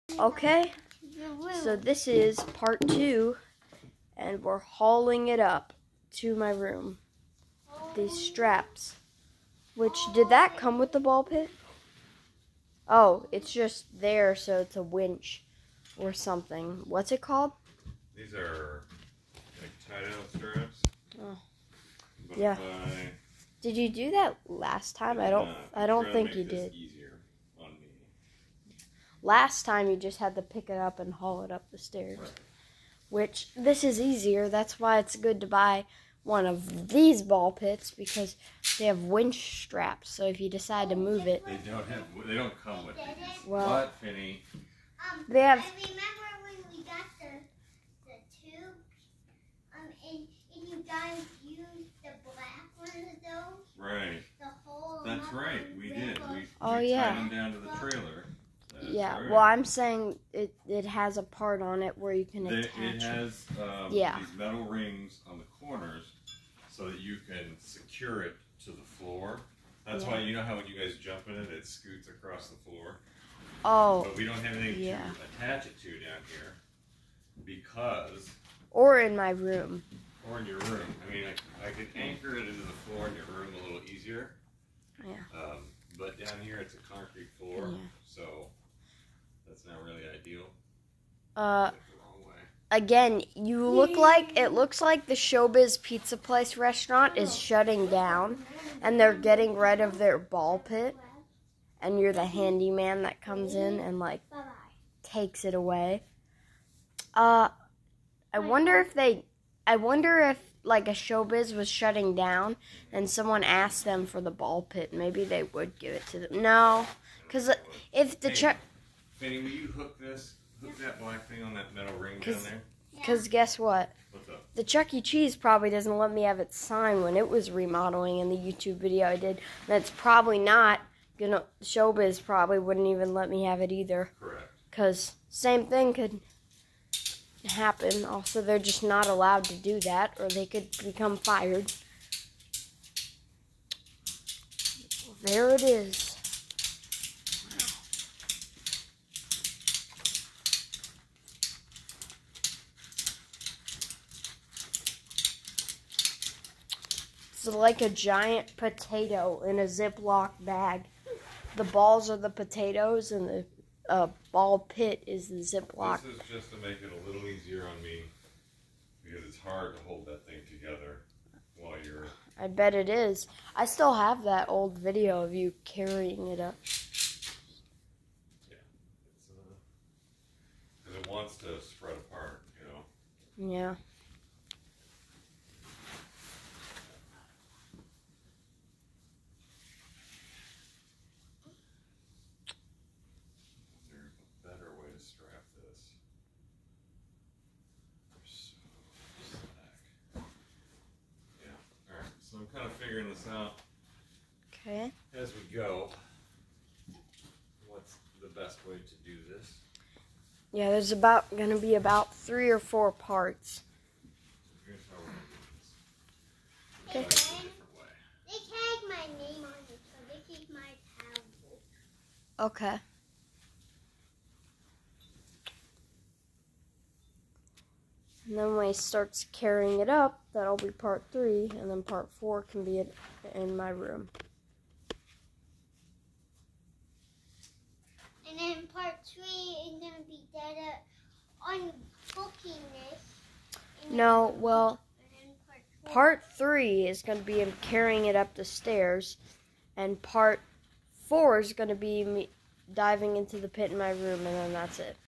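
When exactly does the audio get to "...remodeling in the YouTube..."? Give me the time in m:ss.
2:07.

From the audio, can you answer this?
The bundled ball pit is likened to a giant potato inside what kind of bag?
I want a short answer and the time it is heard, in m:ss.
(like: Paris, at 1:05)
Ziploc bag, at 2:39.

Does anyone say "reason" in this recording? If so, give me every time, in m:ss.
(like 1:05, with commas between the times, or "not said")
not said.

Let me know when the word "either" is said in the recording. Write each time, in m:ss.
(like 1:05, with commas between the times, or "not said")
2:13.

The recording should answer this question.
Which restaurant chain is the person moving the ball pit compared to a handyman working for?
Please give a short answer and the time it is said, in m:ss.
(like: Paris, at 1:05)
Showbiz Pizza Place, at 1:35.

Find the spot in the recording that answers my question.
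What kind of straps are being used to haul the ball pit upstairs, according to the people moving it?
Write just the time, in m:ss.
0:20.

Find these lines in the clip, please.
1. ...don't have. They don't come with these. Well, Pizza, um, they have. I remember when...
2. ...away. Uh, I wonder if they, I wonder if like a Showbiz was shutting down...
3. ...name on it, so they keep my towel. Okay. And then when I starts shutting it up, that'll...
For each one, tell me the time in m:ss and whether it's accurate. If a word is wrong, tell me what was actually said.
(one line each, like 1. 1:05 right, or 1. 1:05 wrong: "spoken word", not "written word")
1. 0:41 wrong: "Finny", not "Pizza"
2. 1:45 right
3. 3:39 wrong: "carrying", not "shutting".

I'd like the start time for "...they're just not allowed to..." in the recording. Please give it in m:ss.
2:18.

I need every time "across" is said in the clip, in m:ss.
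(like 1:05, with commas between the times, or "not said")
1:12.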